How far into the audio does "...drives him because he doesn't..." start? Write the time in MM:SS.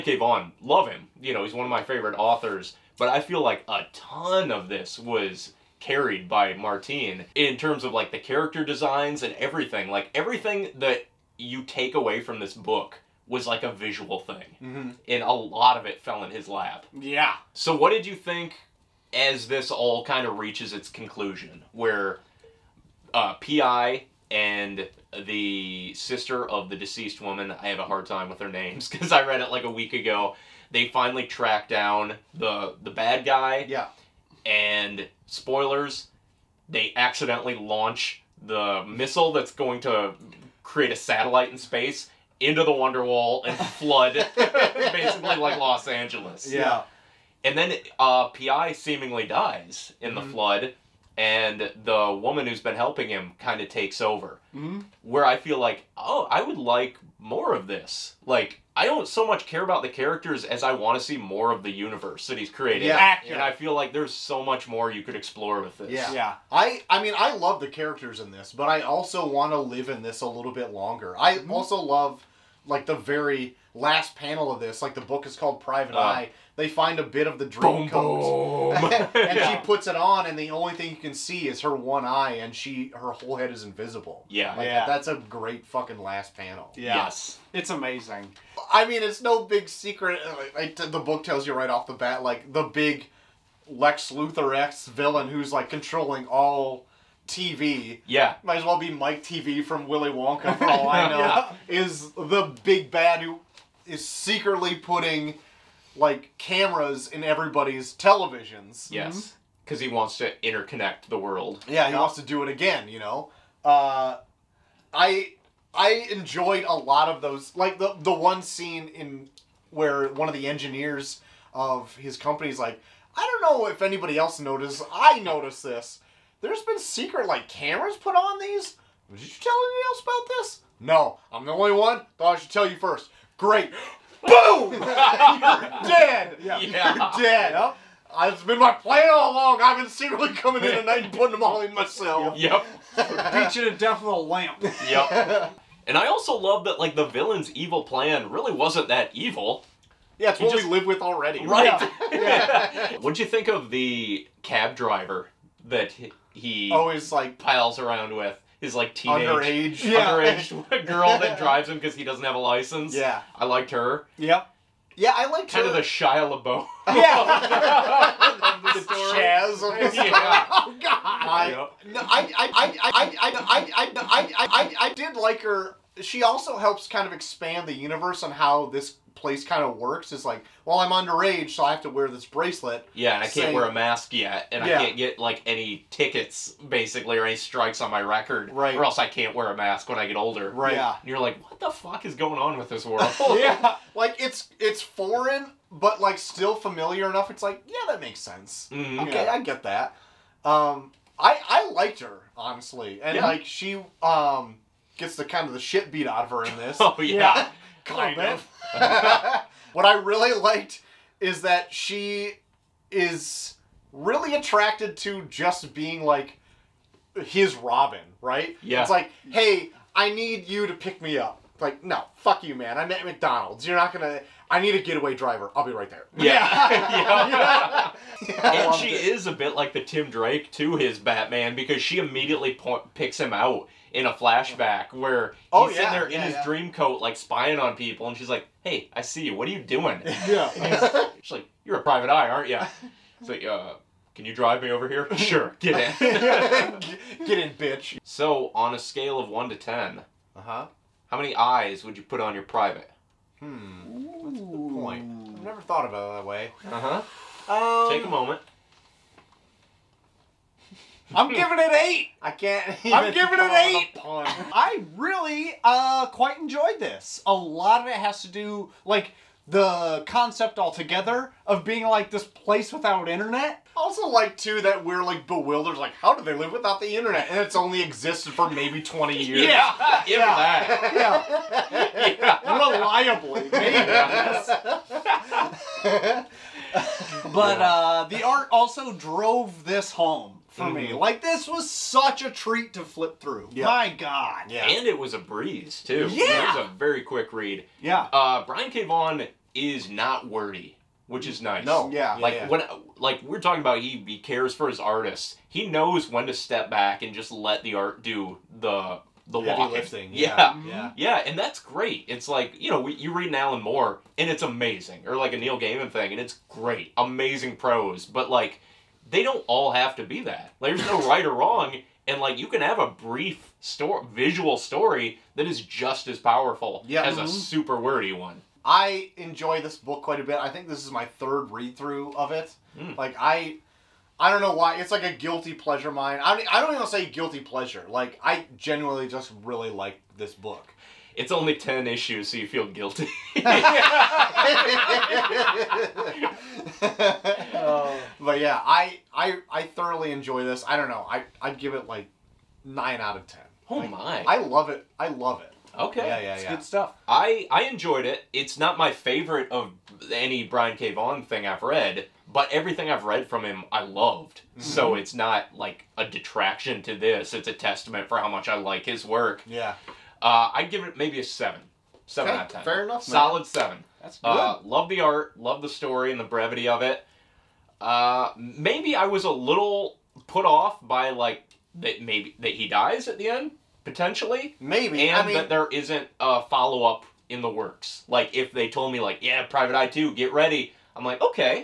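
02:41.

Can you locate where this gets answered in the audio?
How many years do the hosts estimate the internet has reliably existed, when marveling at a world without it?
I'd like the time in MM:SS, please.
04:38.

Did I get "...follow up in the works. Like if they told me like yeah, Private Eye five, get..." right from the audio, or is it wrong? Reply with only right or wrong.
wrong.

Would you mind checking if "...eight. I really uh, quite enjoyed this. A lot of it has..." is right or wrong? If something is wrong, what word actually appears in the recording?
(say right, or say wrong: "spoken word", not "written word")
right.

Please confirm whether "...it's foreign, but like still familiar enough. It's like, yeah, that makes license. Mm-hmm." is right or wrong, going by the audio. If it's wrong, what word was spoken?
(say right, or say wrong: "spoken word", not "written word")
wrong: "sense", not "license".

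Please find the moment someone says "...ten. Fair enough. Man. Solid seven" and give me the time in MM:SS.
06:12.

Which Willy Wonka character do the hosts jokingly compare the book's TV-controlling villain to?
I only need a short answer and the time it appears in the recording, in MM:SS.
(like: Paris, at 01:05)
Mike TV, at 01:38.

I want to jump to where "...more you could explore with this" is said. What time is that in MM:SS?
01:04.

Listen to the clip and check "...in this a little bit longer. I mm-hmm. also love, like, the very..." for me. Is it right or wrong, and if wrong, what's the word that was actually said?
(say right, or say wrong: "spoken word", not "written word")
right.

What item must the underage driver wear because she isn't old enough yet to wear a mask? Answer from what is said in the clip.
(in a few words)
Bracelet.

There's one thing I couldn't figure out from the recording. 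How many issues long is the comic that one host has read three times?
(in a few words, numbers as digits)
10.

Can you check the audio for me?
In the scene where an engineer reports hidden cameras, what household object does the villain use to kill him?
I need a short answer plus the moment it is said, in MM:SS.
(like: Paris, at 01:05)
A lamp, at 02:24.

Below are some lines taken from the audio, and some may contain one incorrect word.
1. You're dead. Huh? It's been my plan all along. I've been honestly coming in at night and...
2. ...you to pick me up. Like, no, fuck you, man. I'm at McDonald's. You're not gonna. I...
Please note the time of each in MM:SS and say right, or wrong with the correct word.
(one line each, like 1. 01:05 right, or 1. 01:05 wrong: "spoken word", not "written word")
1. 02:17 wrong: "secretly", not "honestly"
2. 03:40 right.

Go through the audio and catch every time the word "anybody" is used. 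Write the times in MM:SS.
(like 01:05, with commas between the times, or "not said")
02:03, 02:09.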